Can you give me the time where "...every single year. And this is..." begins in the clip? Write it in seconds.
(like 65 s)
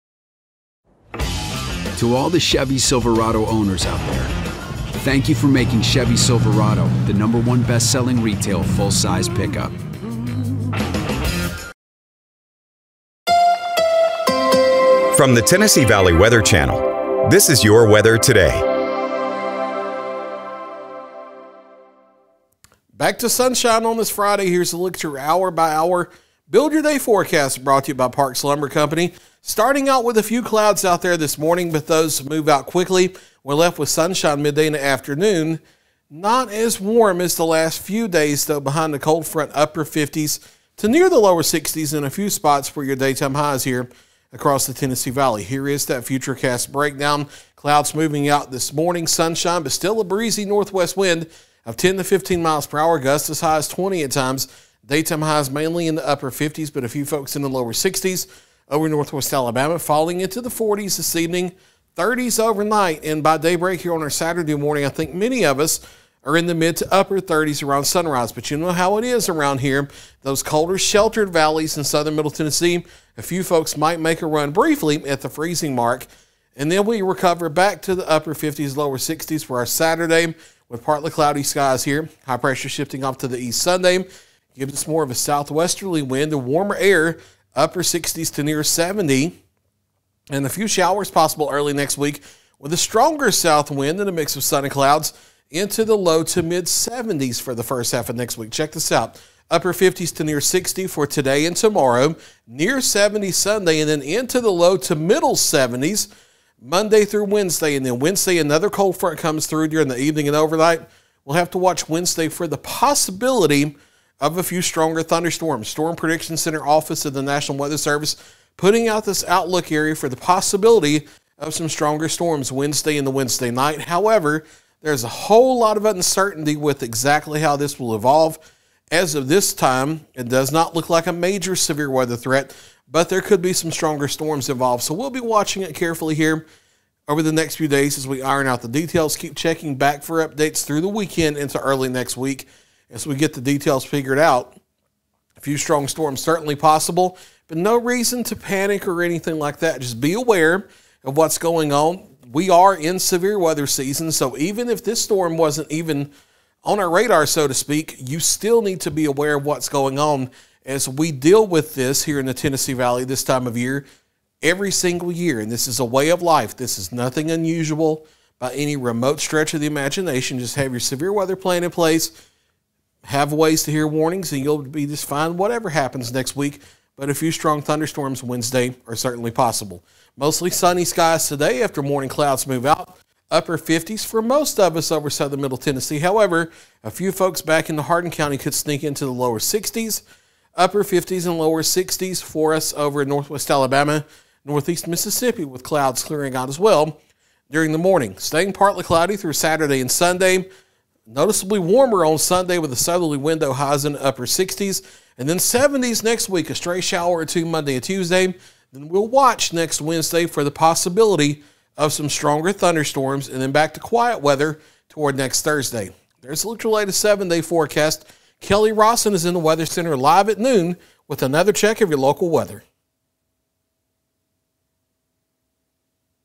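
164 s.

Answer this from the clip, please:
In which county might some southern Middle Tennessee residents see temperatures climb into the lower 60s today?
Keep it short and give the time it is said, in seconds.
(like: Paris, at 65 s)
Hardin County, at 187 s.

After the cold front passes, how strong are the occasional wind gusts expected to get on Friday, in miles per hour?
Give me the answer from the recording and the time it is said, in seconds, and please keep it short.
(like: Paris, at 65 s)
20, at 52 s.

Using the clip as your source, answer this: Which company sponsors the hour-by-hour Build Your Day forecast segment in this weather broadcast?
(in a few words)
Parks Lumber Company.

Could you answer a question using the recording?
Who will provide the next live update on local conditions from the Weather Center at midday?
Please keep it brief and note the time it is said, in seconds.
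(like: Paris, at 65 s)
Kelli Rosson, at 218 s.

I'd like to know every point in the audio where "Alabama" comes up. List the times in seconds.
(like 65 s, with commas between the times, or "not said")
59 s, 193 s.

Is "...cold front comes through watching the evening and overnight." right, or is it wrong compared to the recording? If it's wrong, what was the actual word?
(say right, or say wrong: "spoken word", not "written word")
wrong: "during", not "watching".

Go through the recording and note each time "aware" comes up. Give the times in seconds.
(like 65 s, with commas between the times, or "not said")
150 s, 159 s.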